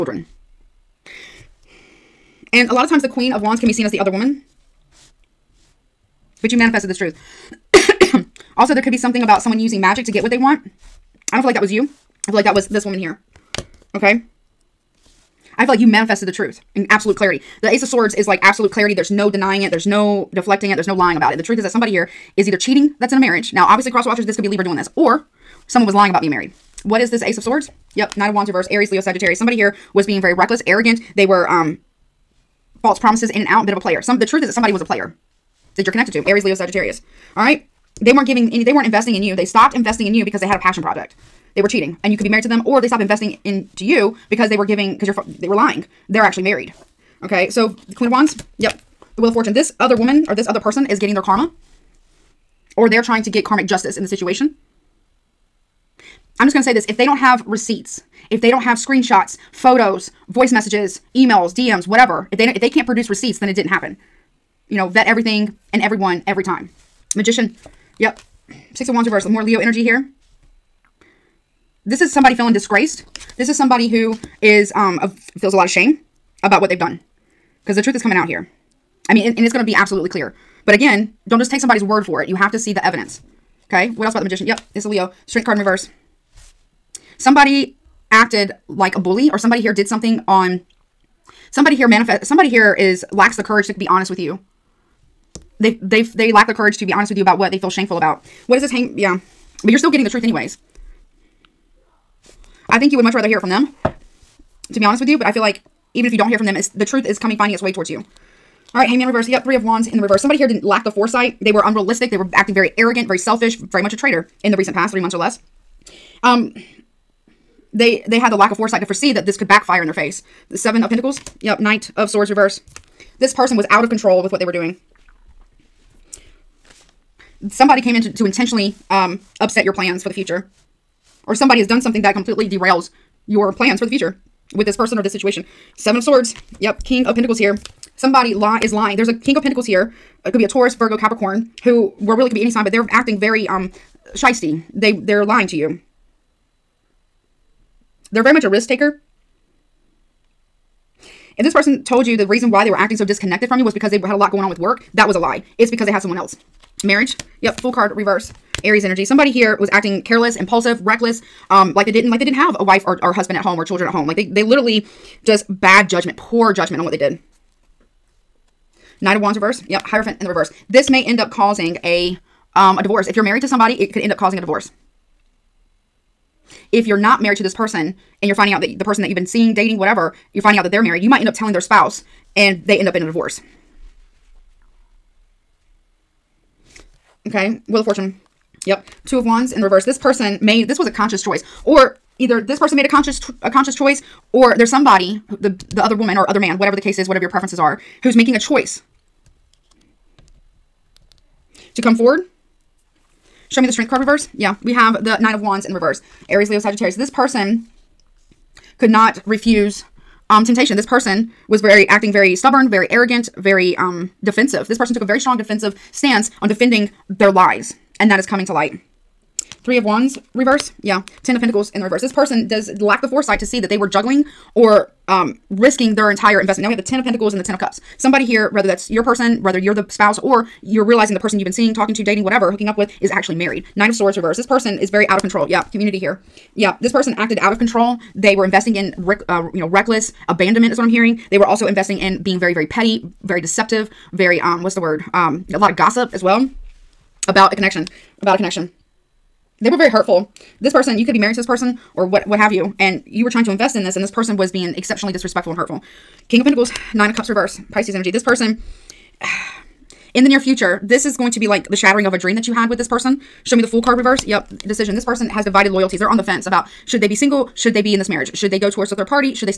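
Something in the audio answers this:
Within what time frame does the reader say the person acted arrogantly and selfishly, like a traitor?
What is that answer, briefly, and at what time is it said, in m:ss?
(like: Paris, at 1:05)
3 months or less, at 1:54.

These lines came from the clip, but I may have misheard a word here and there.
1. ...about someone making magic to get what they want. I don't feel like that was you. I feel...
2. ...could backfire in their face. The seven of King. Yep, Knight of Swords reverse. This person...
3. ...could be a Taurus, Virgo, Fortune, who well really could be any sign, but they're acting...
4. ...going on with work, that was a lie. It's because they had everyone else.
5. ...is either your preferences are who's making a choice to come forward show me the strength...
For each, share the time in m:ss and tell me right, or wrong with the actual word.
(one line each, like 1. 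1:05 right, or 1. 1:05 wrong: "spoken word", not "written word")
1. 0:09 wrong: "using", not "making"
2. 1:59 wrong: "Pentacles", not "King"
3. 2:20 wrong: "Capricorn", not "Fortune"
4. 2:34 wrong: "someone", not "everyone"
5. 3:16 wrong: "whatever", not "either".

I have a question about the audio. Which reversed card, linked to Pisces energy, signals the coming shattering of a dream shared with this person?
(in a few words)
Nine of Cups.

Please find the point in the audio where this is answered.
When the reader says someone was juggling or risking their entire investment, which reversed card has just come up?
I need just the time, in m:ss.
3:41.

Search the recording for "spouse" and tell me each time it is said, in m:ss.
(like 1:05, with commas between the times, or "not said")
3:01, 3:49.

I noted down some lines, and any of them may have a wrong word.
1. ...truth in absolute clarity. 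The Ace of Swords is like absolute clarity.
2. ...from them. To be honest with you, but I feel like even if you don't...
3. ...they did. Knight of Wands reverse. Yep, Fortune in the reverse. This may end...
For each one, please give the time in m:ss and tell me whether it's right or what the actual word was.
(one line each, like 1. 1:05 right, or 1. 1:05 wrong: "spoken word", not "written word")
1. 0:16 right
2. 1:43 right
3. 2:46 wrong: "Hierophant", not "Fortune".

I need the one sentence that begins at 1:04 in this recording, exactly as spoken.
You know, vet everything and everyone every time.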